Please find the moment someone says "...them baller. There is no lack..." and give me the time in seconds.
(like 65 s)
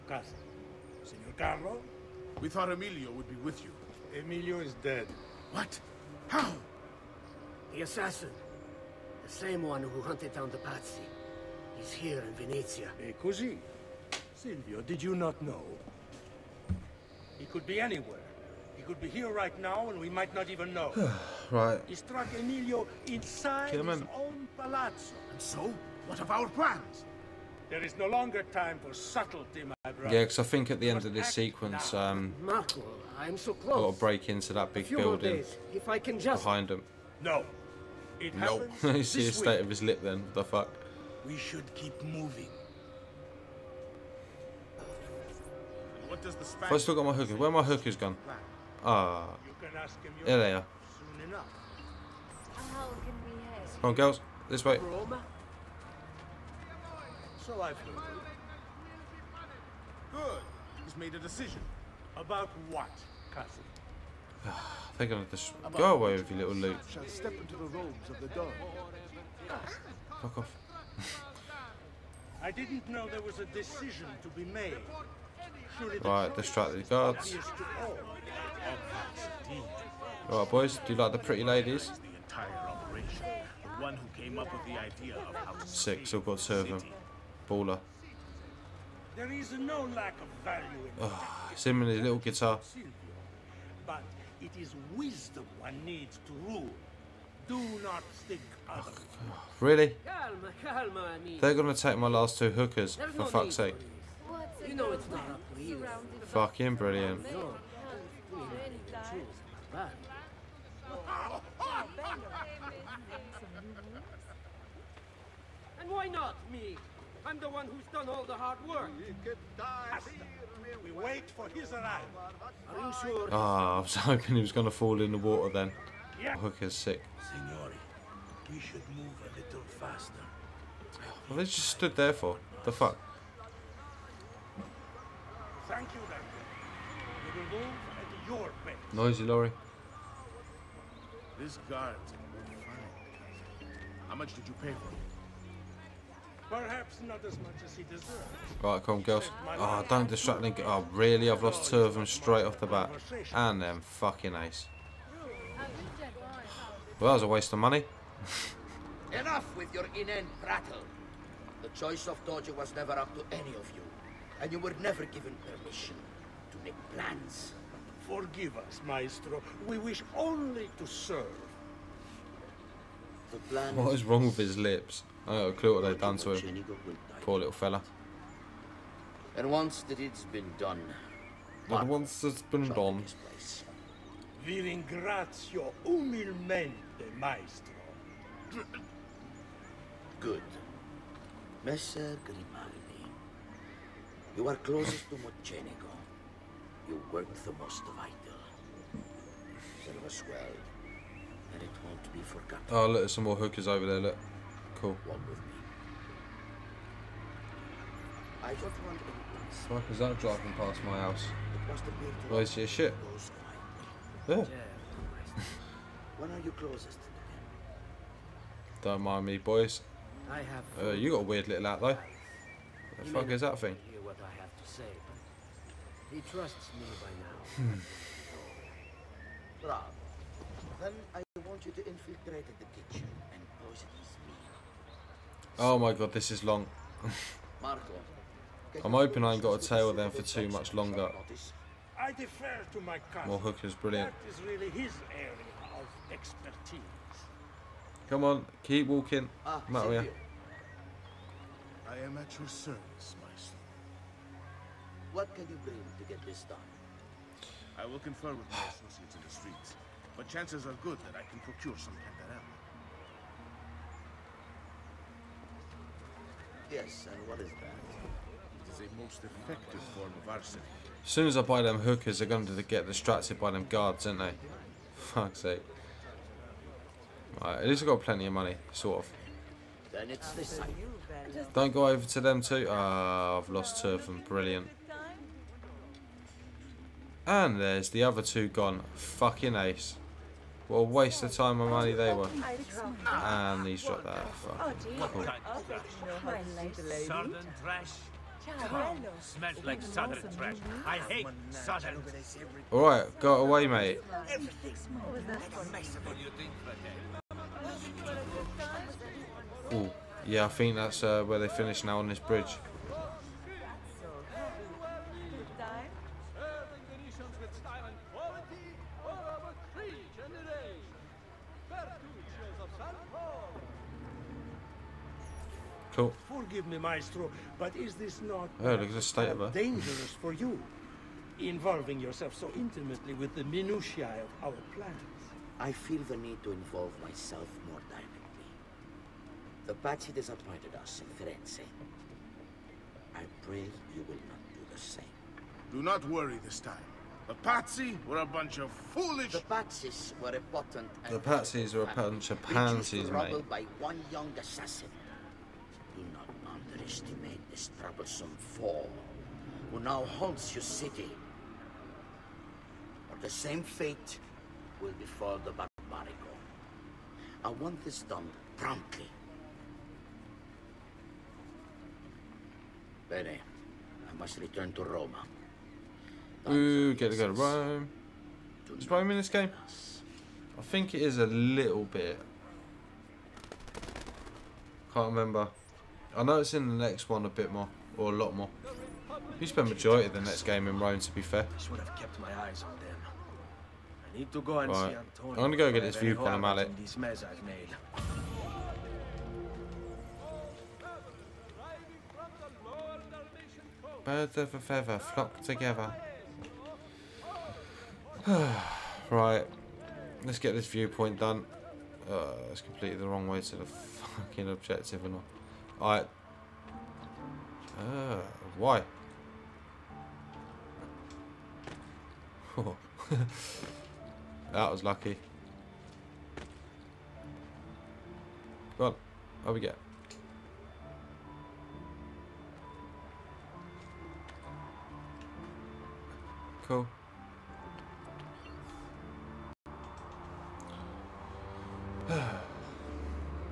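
86 s.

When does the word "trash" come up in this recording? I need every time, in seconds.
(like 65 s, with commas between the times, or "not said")
300 s.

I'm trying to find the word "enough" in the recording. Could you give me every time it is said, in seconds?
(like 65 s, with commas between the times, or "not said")
51 s, 159 s.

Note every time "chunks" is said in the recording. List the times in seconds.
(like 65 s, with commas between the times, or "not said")
not said.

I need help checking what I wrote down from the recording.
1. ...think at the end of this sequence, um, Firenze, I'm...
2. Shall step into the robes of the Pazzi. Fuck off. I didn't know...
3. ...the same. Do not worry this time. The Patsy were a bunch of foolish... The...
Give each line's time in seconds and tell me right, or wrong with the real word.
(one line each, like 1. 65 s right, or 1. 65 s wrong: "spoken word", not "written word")
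1. 30 s wrong: "Marco", not "Firenze"
2. 66 s wrong: "Doge", not "Pazzi"
3. 344 s right.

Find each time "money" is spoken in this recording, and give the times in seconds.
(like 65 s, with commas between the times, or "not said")
157 s, 278 s, 291 s.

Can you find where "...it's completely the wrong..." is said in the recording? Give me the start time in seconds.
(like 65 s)
412 s.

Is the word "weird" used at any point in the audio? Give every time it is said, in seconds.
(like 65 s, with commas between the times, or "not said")
221 s.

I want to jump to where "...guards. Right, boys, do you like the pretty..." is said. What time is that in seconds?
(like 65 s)
76 s.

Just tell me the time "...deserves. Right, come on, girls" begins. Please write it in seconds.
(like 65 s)
147 s.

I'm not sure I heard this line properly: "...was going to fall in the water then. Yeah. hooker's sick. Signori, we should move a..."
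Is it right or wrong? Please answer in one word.
right.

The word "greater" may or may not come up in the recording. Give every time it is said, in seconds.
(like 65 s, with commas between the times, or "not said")
not said.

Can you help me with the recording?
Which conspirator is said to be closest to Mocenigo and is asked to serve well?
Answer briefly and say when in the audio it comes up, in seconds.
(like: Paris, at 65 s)
Messer Grimaldi, at 191 s.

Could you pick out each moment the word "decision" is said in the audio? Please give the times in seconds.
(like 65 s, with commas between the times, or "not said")
61 s, 73 s.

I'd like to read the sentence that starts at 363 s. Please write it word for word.
Or the same fate will befall the Barbarigo.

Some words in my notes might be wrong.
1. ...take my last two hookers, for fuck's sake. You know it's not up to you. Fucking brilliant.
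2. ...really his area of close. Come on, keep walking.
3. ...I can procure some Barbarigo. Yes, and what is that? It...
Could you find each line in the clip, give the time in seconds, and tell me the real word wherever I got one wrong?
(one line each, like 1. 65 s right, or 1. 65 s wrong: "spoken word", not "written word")
1. 101 s right
2. 244 s wrong: "expertise", not "close"
3. 261 s wrong: "Cantarella", not "Barbarigo".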